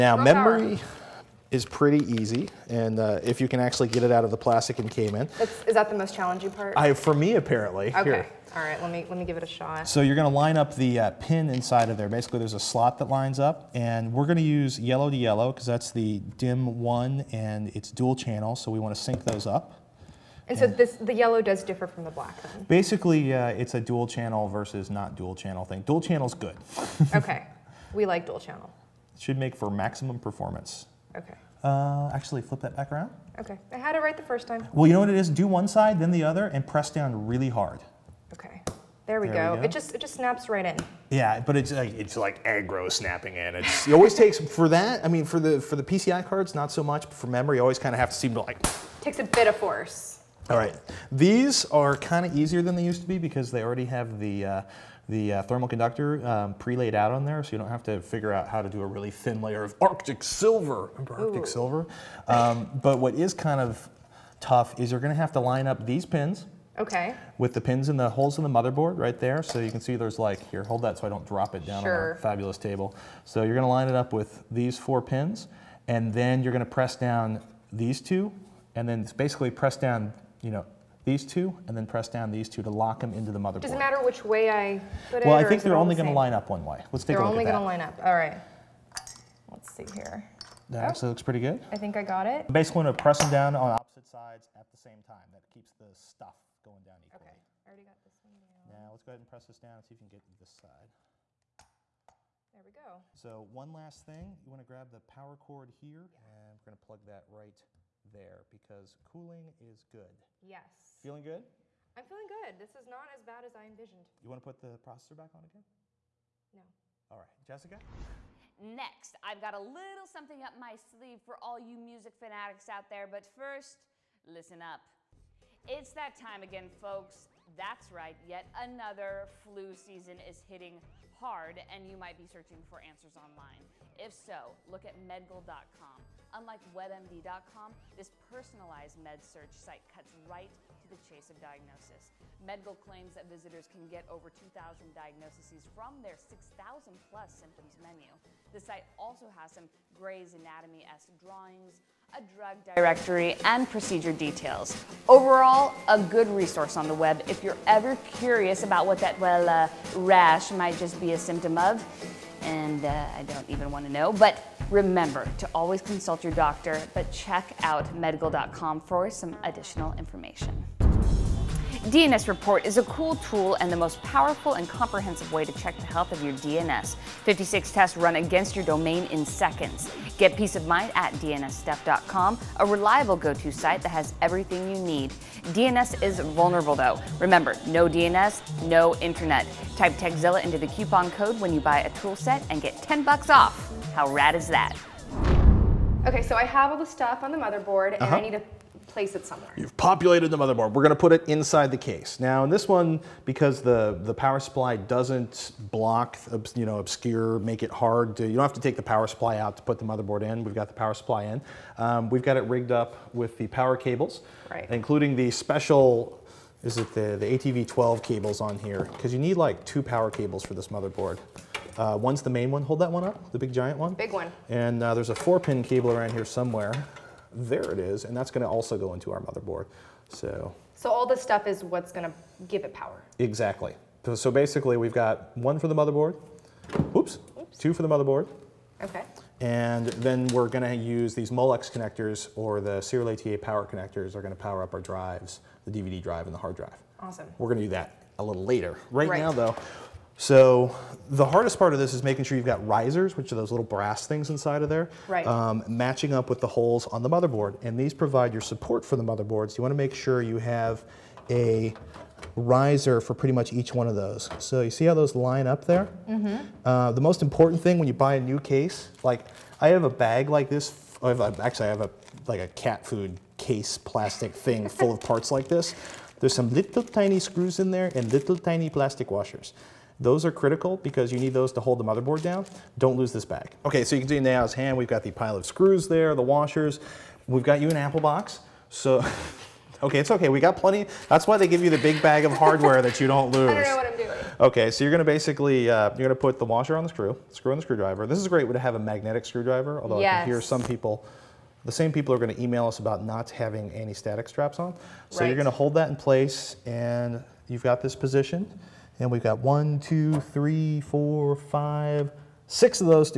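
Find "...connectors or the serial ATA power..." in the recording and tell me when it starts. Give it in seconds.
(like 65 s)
241 s.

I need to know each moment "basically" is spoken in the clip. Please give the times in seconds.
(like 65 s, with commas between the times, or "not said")
12 s, 22 s, 79 s, 92 s, 234 s, 295 s.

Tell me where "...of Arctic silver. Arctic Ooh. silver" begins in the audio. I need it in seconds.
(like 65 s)
59 s.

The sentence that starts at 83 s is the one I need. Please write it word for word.
Does it matter which way I put it?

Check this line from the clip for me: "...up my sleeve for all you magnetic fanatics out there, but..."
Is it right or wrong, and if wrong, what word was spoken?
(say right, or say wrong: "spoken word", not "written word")
wrong: "music", not "magnetic".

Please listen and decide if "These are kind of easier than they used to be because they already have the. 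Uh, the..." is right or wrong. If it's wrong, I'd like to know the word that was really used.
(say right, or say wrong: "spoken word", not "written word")
right.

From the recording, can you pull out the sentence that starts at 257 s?
And these provide your support for the motherboards.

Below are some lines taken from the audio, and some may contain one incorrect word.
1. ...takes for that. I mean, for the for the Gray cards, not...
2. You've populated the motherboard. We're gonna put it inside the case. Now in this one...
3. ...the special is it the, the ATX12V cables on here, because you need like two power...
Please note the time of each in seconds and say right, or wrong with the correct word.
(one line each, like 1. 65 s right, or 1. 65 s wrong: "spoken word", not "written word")
1. 44 s wrong: "PCI", not "Gray"
2. 199 s right
3. 215 s right.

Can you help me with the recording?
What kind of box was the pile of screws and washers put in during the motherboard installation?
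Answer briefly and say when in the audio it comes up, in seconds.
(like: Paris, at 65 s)
An Apple box, at 287 s.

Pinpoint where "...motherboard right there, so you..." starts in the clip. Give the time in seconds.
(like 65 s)
68 s.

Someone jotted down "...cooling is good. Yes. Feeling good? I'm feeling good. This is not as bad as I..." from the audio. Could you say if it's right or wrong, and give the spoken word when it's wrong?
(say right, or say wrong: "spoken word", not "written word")
right.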